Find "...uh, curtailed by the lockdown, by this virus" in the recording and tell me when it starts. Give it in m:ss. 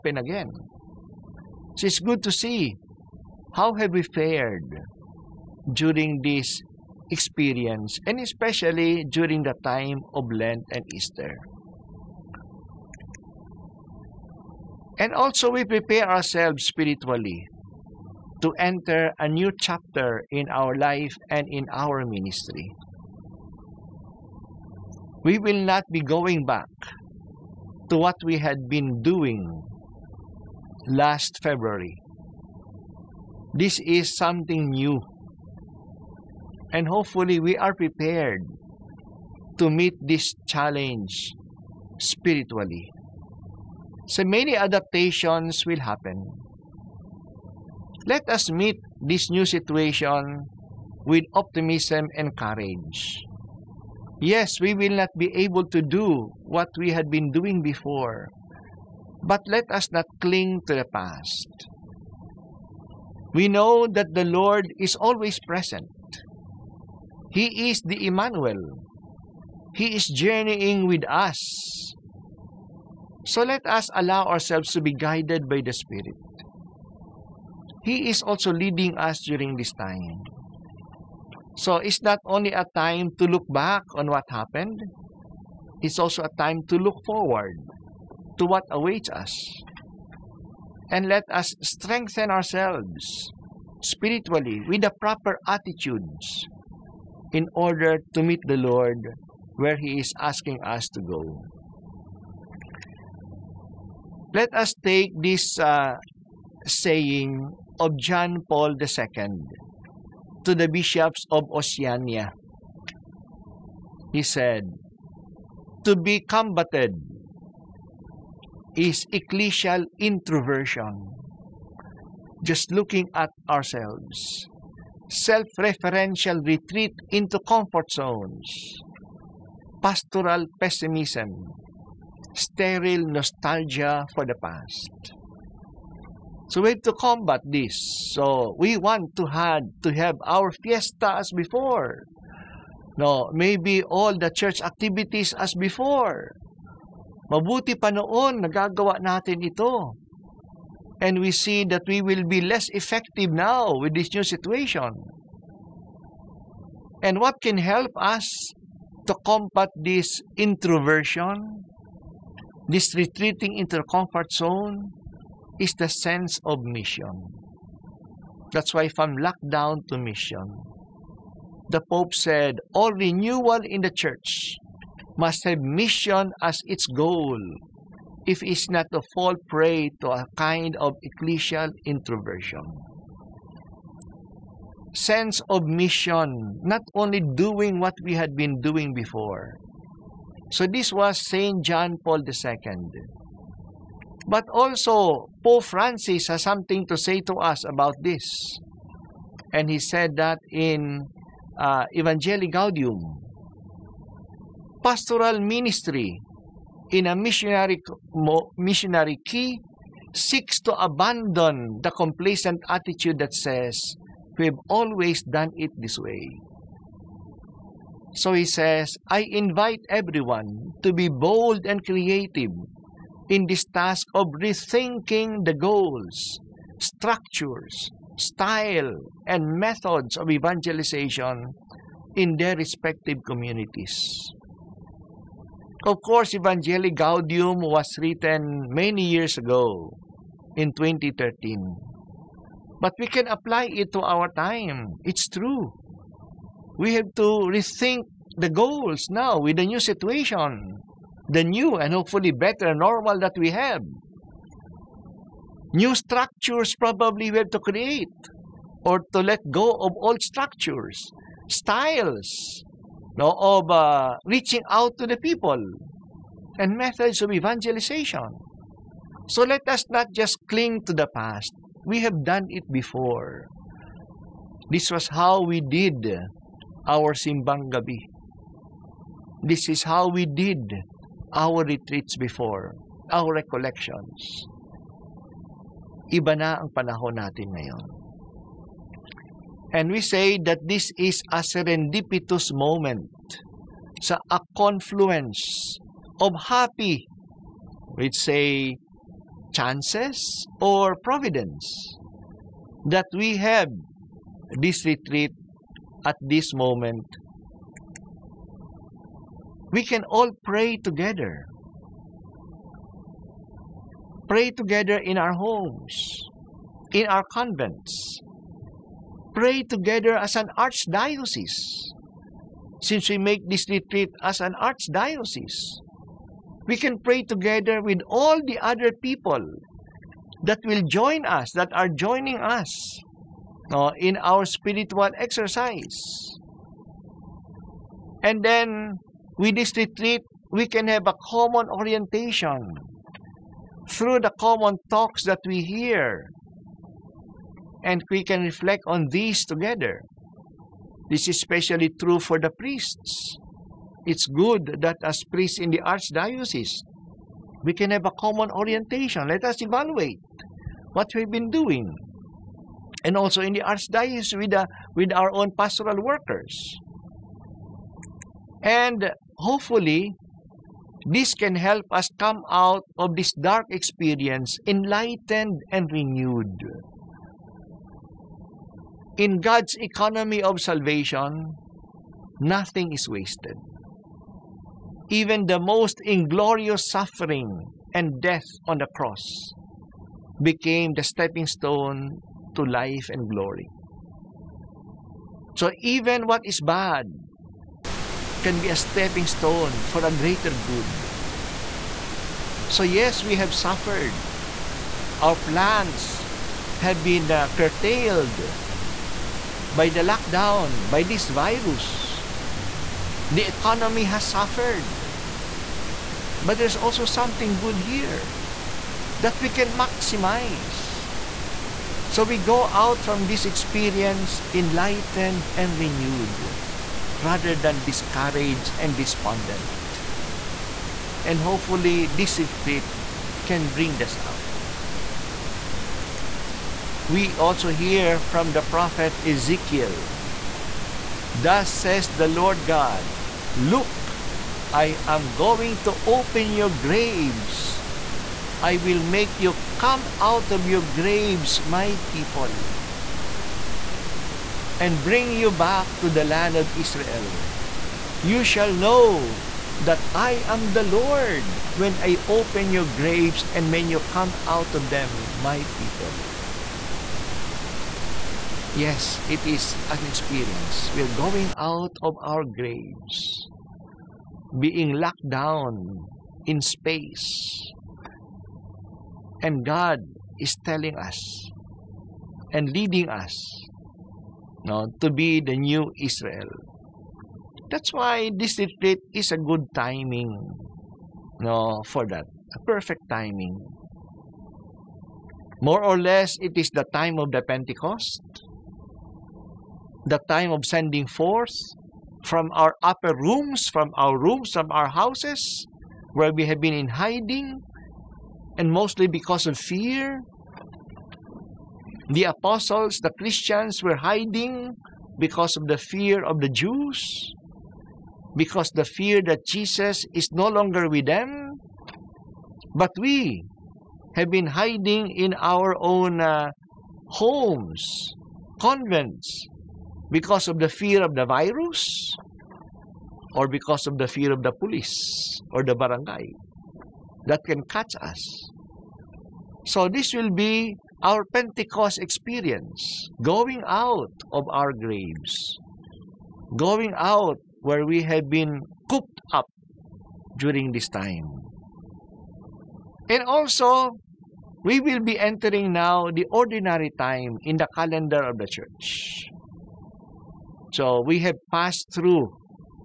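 6:47.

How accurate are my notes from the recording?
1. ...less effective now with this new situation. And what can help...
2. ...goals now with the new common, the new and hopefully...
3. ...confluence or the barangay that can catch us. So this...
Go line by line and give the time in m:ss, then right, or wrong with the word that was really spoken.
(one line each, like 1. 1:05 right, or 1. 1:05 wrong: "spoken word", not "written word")
1. 2:32 right
2. 4:08 wrong: "situation", not "common"
3. 8:54 wrong: "police", not "confluence".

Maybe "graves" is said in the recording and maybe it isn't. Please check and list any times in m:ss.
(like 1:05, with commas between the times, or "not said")
7:26, 7:30, 7:42, 7:52, 9:04.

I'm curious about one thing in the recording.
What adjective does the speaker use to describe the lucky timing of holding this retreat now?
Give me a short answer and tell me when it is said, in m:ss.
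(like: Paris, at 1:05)
Serendipitous, at 4:51.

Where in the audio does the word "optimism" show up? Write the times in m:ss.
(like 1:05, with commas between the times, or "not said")
0:51.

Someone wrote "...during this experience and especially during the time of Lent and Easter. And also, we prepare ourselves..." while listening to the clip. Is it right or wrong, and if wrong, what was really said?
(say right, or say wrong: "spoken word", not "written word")
right.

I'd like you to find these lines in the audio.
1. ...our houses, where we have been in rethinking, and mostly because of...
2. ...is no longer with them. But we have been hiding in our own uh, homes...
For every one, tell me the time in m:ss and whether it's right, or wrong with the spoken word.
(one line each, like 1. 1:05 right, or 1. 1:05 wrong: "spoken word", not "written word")
1. 8:24 wrong: "hiding", not "rethinking"
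2. 8:40 right.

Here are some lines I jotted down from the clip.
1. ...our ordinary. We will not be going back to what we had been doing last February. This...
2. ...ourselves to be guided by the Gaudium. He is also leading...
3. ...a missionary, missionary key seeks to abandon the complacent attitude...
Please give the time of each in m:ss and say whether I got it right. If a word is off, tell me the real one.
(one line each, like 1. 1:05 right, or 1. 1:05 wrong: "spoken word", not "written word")
1. 0:21 wrong: "ministry", not "ordinary"
2. 1:14 wrong: "Spirit", not "Gaudium"
3. 3:27 right.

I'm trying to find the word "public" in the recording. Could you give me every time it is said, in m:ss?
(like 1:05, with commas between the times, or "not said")
not said.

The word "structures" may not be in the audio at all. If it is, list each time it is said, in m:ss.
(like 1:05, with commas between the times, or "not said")
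3:46, 4:15, 4:20.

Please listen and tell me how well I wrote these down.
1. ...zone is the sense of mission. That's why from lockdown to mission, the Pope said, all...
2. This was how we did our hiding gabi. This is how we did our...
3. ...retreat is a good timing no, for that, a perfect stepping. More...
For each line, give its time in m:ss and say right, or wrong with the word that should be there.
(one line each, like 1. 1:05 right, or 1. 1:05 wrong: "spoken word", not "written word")
1. 2:44 right
2. 4:34 wrong: "simbang", not "hiding"
3. 8:08 wrong: "timing", not "stepping".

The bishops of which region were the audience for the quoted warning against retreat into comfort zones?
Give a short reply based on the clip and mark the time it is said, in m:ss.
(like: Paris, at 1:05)
Oceania, at 1:51.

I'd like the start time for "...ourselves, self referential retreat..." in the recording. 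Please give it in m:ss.
2:03.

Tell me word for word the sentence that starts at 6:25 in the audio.
Even the most inglorious suffering and death on the cross became the stepping stone to life and glory.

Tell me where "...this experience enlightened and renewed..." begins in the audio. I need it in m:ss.
7:03.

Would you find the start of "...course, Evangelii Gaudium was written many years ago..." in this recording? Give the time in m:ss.
3:56.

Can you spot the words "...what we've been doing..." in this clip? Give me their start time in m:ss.
6:00.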